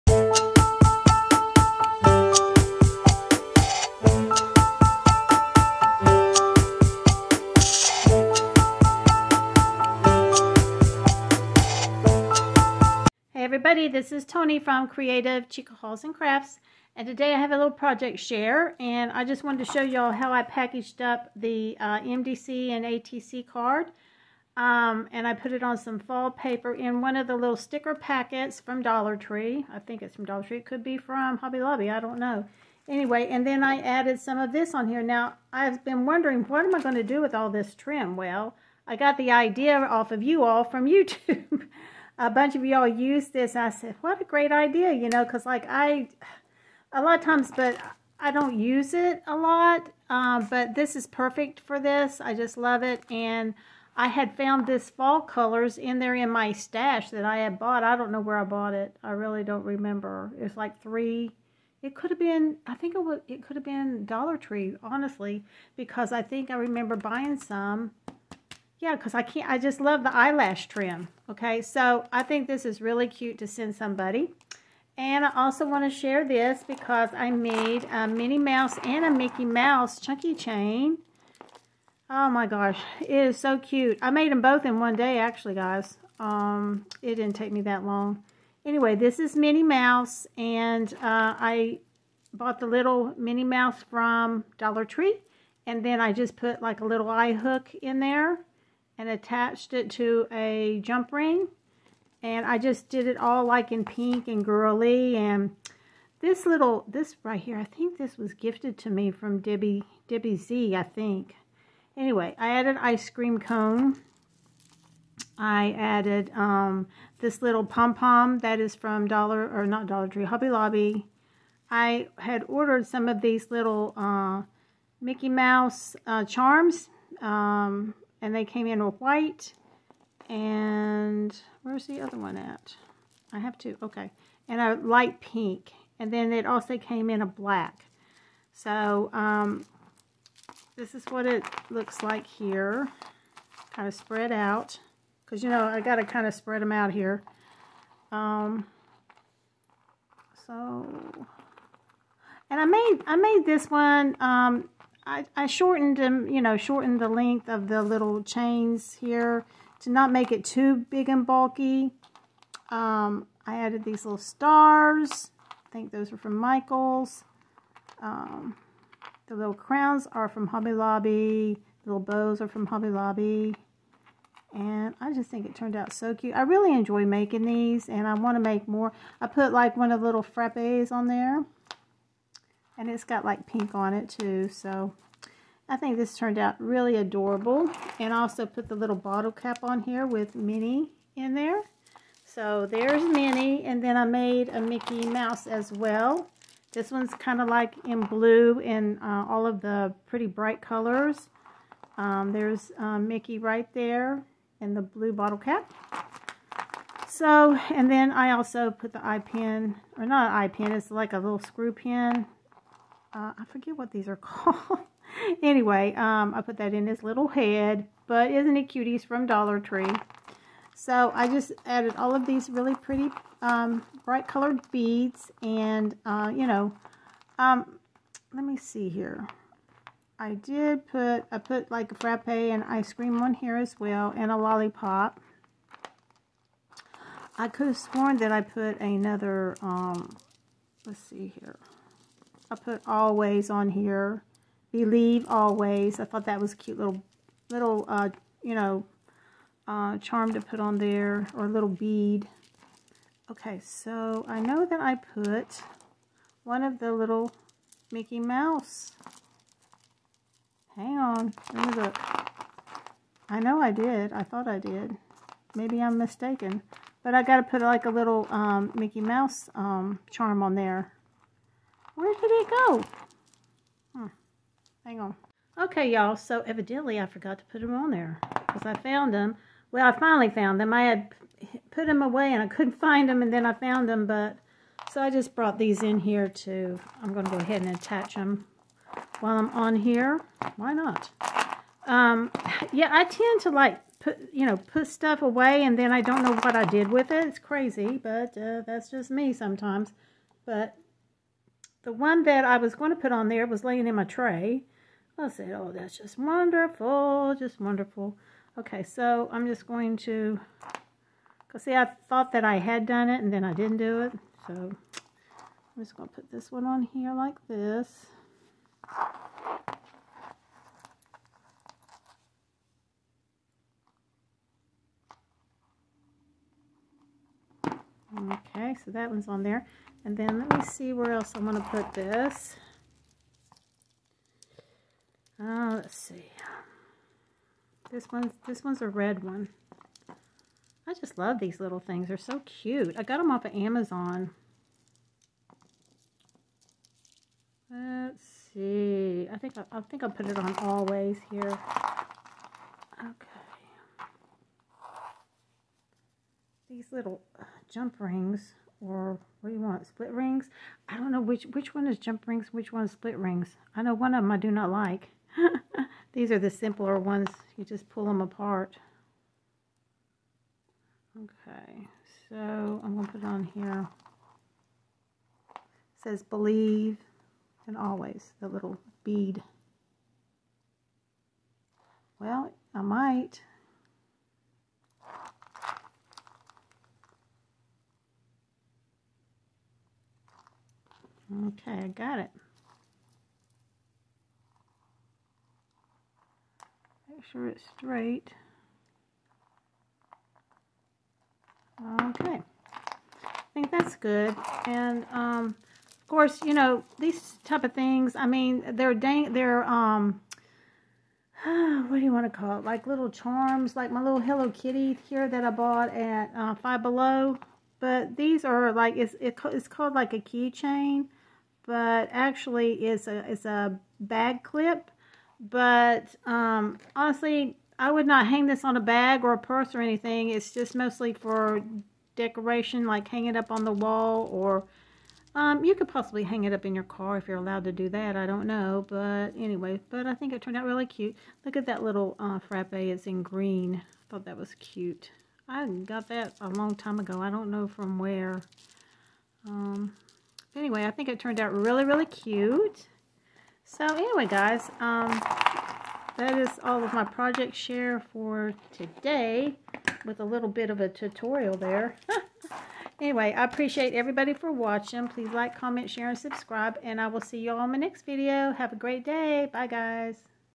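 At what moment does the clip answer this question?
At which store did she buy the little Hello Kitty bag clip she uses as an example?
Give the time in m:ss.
6:56.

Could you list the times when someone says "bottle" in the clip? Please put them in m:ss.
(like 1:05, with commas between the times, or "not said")
3:08, 3:25.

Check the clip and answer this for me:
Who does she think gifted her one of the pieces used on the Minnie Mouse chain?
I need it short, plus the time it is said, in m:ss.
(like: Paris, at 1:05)
Debbie Z, at 1:50.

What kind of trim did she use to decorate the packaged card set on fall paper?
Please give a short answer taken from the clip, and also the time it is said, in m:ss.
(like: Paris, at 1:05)
Eyelash trim, at 1:10.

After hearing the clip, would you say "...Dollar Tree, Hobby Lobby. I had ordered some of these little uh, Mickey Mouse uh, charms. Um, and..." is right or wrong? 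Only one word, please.
right.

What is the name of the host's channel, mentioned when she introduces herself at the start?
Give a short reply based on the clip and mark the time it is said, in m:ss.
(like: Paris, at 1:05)
Creative Chica Hauls and Crafts, at 0:14.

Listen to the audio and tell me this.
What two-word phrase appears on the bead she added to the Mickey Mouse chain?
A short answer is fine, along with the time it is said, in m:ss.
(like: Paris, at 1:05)
Believe always, at 4:04.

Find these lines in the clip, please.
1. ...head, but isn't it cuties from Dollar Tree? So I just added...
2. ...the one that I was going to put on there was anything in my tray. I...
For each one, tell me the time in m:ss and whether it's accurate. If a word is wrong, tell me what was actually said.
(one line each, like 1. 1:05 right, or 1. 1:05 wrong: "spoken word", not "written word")
1. 3:37 right
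2. 5:01 wrong: "laying", not "anything".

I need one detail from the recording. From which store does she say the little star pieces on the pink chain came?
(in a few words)
Michaels.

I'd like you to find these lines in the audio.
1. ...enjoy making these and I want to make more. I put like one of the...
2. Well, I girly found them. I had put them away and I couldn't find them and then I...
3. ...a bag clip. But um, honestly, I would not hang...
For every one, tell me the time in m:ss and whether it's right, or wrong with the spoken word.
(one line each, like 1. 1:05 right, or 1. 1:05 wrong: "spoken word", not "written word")
1. 2:56 right
2. 4:39 wrong: "finally", not "girly"
3. 7:03 right.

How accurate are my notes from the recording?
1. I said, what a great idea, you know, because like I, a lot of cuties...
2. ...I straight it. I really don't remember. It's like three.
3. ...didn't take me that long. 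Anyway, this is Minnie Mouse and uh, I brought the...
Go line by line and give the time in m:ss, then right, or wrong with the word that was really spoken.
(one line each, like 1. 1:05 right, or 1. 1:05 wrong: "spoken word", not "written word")
1. 0:43 wrong: "times", not "cuties"
2. 0:58 wrong: "bought", not "straight"
3. 1:27 wrong: "bought", not "brought".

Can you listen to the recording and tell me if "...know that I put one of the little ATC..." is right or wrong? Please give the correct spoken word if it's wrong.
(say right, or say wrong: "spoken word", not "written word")
wrong: "Mickey", not "ATC".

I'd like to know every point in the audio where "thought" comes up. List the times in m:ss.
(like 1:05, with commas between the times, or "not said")
4:06, 4:24, 5:12, 7:24.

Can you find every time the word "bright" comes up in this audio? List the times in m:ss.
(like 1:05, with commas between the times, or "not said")
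3:20, 3:44.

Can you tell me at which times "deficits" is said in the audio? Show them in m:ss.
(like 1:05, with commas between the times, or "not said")
not said.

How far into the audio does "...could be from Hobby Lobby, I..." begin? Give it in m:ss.
0:30.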